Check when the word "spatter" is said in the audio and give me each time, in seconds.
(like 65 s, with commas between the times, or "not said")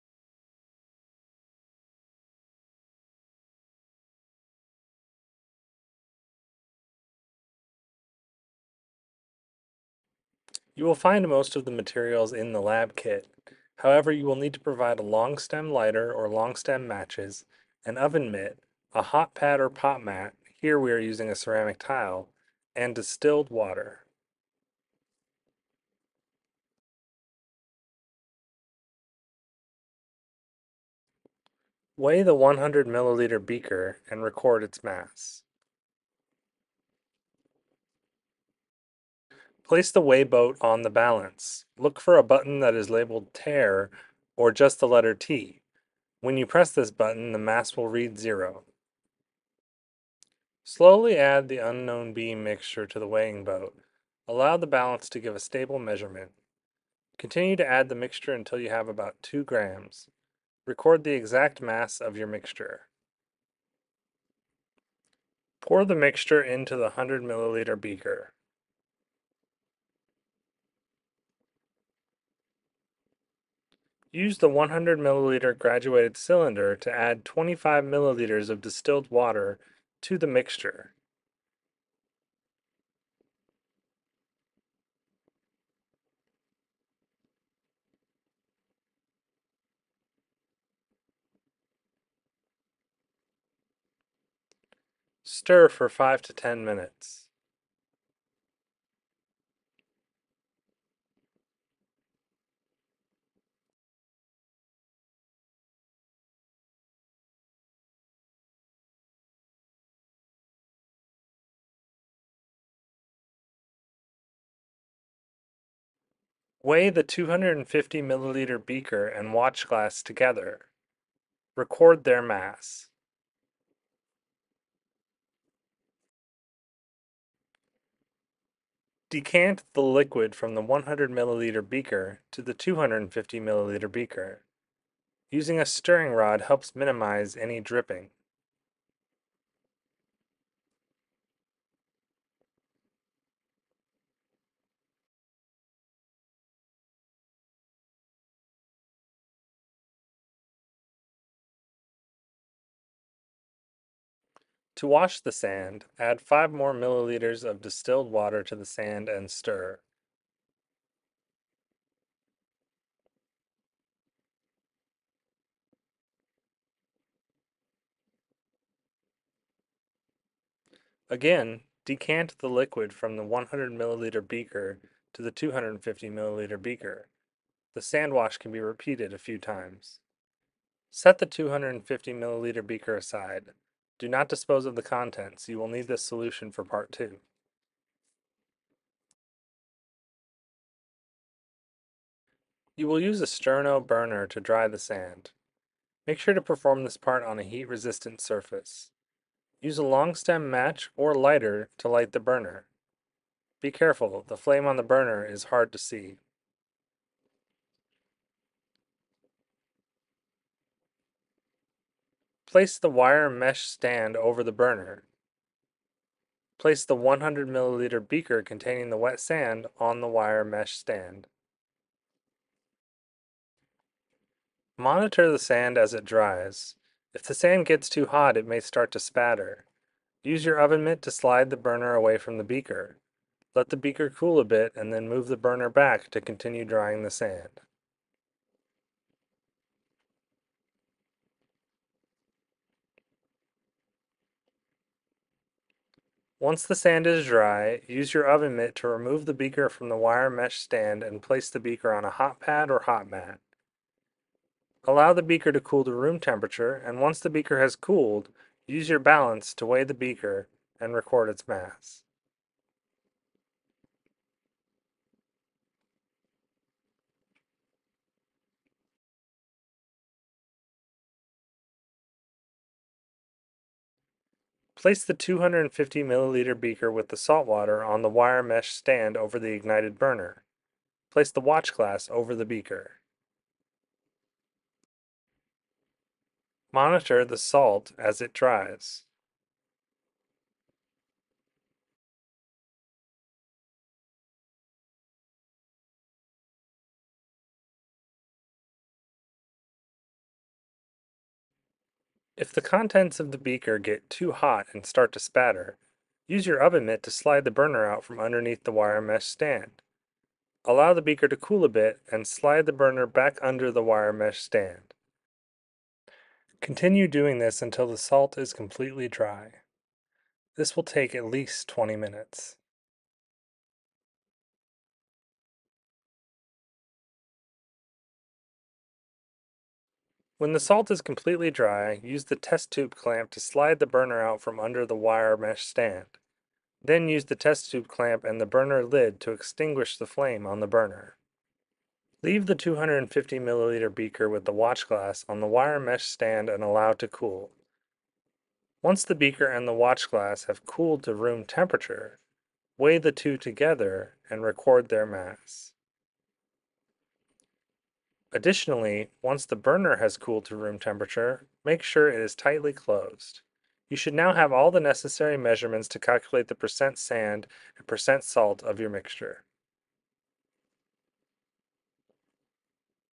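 228 s, 305 s.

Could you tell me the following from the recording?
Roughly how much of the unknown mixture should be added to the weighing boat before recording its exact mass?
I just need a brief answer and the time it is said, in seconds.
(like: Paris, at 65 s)
2 grams, at 59 s.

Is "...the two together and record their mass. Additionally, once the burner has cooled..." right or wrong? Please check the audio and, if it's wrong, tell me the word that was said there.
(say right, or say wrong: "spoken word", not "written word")
right.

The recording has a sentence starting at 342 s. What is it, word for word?
Leave the 250 milliliter beaker with the watch glass on the wire mesh stand and allow to cool.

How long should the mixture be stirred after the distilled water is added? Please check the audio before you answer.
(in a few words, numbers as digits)
5 to 10 minutes.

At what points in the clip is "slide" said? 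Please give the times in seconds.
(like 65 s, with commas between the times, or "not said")
231 s, 307 s, 312 s, 333 s.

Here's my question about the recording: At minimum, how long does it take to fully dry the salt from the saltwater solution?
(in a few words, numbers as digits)
20 minutes.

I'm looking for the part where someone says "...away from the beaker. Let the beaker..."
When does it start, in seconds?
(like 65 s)
231 s.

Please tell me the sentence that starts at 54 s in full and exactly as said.
Allow the balance to give a stable measurement.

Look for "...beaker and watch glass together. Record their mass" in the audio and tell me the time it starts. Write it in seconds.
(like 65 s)
118 s.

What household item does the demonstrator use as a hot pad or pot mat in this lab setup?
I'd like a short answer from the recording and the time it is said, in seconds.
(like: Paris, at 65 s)
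ceramic tile, at 21 s.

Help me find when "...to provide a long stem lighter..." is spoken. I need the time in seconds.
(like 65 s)
14 s.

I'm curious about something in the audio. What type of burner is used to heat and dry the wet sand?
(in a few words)
sterno burner.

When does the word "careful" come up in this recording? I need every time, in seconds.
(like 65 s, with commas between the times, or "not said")
203 s.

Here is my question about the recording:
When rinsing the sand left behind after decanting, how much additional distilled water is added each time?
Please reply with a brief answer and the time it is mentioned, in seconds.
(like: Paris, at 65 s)
5 milliliters, at 156 s.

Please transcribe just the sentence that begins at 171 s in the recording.
Again, decant the liquid from the 100 milliliter beaker to the 250 milliliter beaker.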